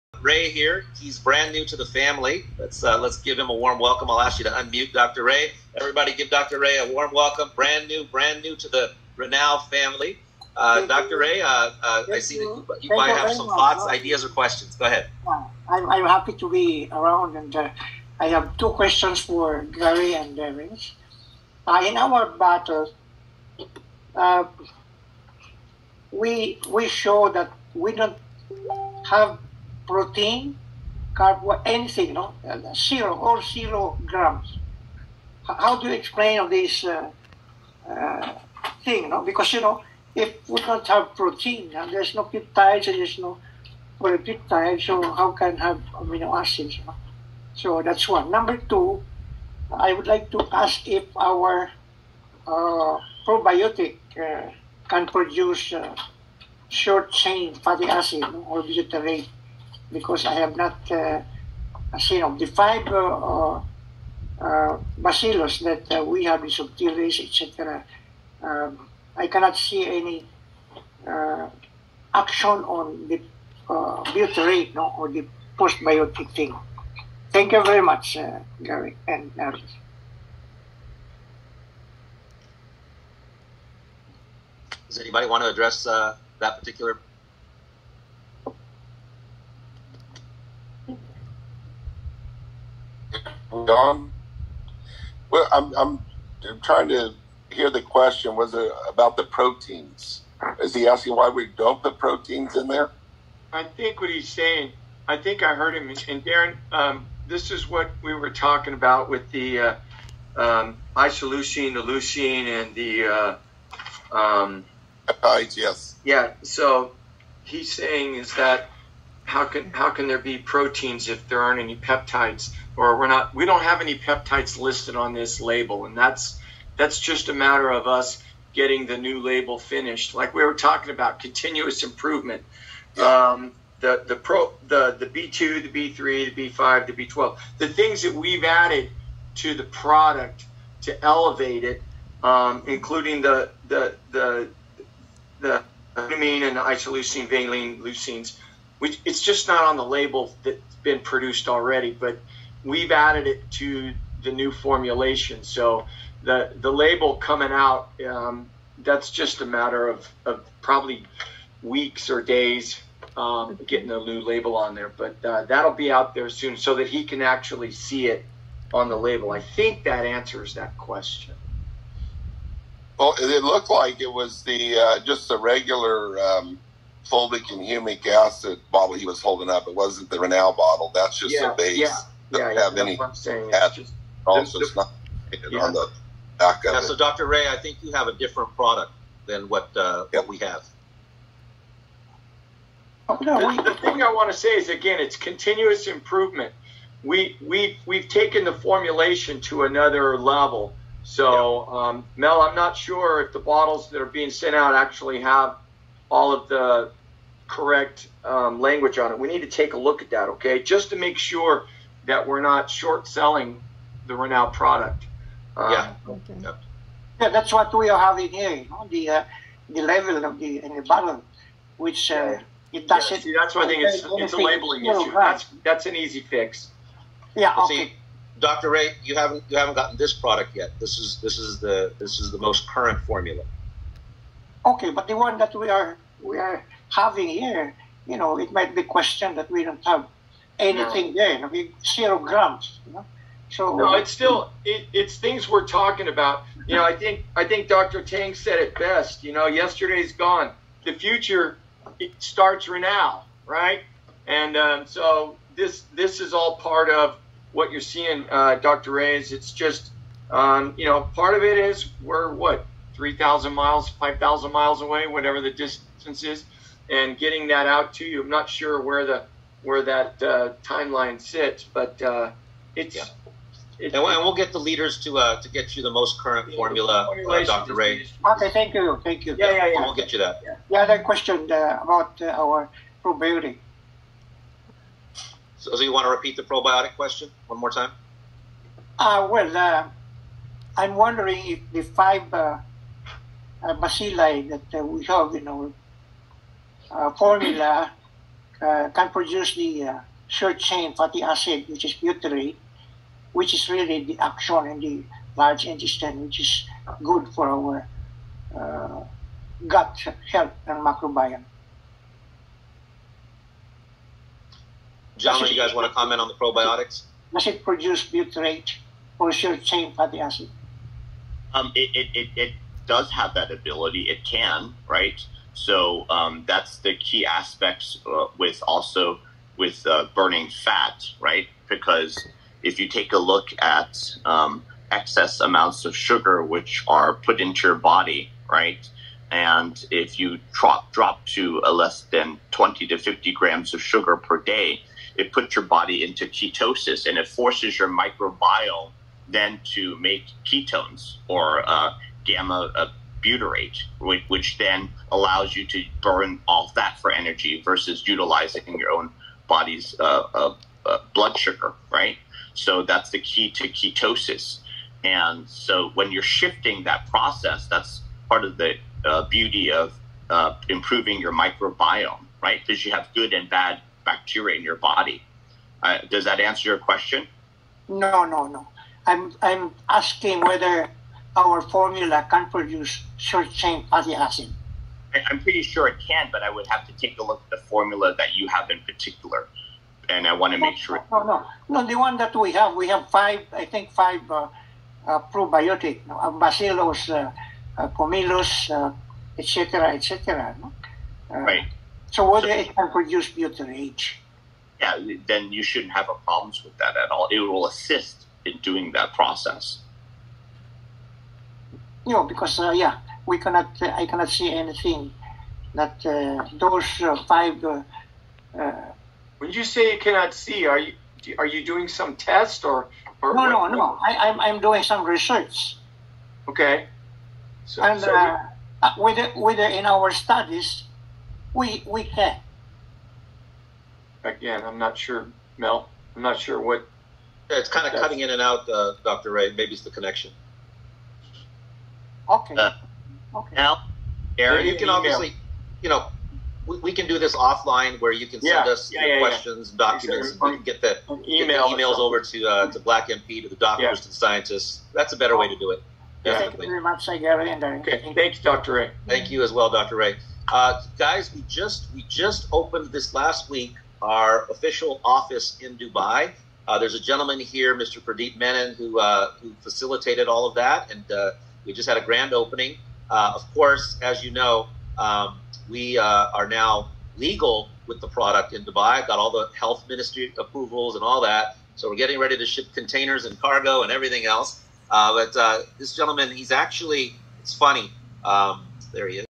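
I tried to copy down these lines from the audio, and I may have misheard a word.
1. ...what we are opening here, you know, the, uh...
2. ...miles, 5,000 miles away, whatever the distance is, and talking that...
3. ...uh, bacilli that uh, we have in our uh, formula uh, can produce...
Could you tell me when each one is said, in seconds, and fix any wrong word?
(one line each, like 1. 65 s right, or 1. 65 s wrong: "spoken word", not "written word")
1. 217 s wrong: "having", not "opening"
2. 263 s wrong: "getting", not "talking"
3. 293 s right.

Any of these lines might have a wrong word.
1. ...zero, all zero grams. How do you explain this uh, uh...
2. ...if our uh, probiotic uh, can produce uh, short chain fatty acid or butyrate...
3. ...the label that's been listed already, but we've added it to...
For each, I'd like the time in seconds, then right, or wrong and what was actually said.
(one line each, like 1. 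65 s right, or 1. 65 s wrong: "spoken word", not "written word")
1. 32 s right
2. 50 s right
3. 149 s wrong: "produced", not "listed".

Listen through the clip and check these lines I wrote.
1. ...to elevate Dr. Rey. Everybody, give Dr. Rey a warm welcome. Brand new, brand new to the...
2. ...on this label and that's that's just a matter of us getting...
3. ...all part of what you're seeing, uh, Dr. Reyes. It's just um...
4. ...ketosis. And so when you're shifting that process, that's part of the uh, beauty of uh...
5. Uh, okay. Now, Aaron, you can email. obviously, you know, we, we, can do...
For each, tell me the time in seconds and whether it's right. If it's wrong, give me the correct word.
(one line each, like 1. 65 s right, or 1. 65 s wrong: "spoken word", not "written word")
1. 4 s wrong: "unmute", not "elevate"
2. 124 s right
3. 256 s right
4. 363 s right
5. 442 s right.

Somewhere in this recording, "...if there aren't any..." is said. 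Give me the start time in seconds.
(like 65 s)
121 s.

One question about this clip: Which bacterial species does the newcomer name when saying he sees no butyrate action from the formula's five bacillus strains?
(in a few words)
subtilis.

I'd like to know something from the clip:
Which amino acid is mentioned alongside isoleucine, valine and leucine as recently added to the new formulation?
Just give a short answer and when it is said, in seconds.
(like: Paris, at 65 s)
glutamine, at 145 s.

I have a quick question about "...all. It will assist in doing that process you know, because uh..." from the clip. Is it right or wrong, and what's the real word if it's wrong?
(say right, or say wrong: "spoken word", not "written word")
right.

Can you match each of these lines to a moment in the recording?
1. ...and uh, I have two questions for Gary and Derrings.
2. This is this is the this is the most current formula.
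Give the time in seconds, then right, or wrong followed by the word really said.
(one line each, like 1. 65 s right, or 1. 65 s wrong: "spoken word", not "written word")
1. 17 s right
2. 230 s right.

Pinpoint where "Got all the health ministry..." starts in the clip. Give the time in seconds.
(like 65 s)
479 s.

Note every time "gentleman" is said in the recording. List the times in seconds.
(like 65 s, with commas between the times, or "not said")
466 s, 485 s.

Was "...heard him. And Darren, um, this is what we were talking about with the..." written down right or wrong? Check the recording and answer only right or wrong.
right.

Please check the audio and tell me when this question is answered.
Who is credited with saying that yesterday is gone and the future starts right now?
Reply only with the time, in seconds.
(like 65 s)
247 s.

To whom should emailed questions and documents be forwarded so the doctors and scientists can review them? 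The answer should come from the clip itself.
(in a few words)
Black MP.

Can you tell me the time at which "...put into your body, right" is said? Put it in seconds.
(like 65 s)
337 s.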